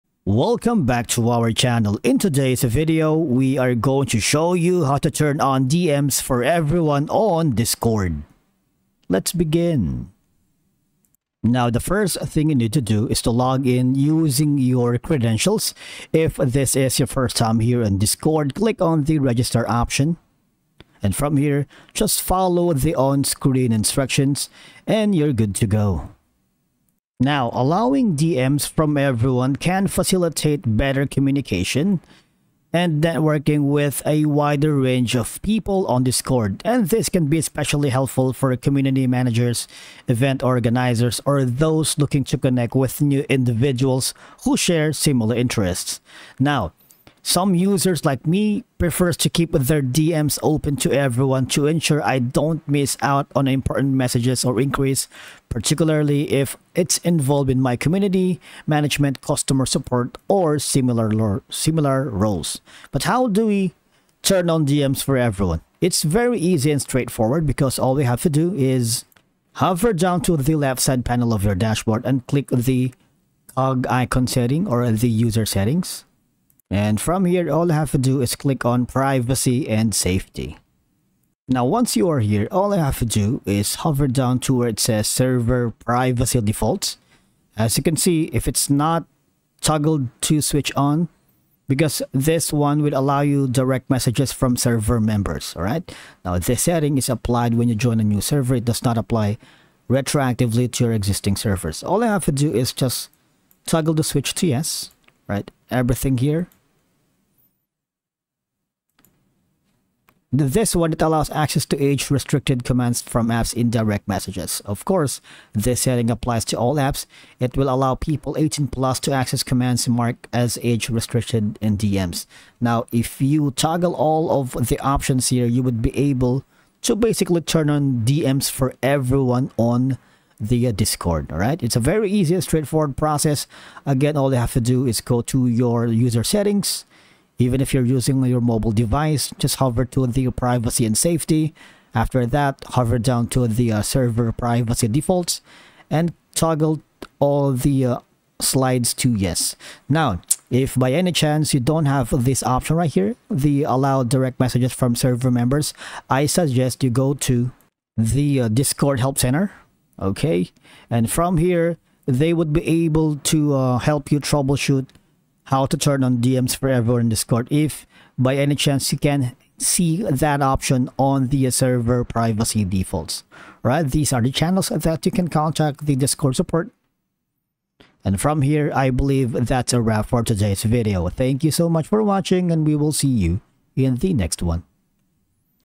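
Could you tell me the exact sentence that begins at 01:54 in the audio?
Of course, this setting applies to all apps.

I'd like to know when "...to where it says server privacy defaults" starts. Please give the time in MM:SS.
01:24.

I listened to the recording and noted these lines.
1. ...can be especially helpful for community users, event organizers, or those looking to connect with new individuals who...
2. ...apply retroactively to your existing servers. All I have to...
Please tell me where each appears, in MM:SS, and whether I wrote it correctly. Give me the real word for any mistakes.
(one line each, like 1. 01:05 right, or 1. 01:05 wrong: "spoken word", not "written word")
1. 00:37 wrong: "managers", not "users"
2. 01:38 right.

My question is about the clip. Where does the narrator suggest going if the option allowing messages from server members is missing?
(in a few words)
Discord Help Center.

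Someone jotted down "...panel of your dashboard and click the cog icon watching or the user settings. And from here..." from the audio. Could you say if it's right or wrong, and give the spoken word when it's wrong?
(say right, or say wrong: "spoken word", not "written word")
wrong: "setting", not "watching".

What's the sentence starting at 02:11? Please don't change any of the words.
All right, it's a very easy, straightforward process.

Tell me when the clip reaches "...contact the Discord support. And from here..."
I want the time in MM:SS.
02:55.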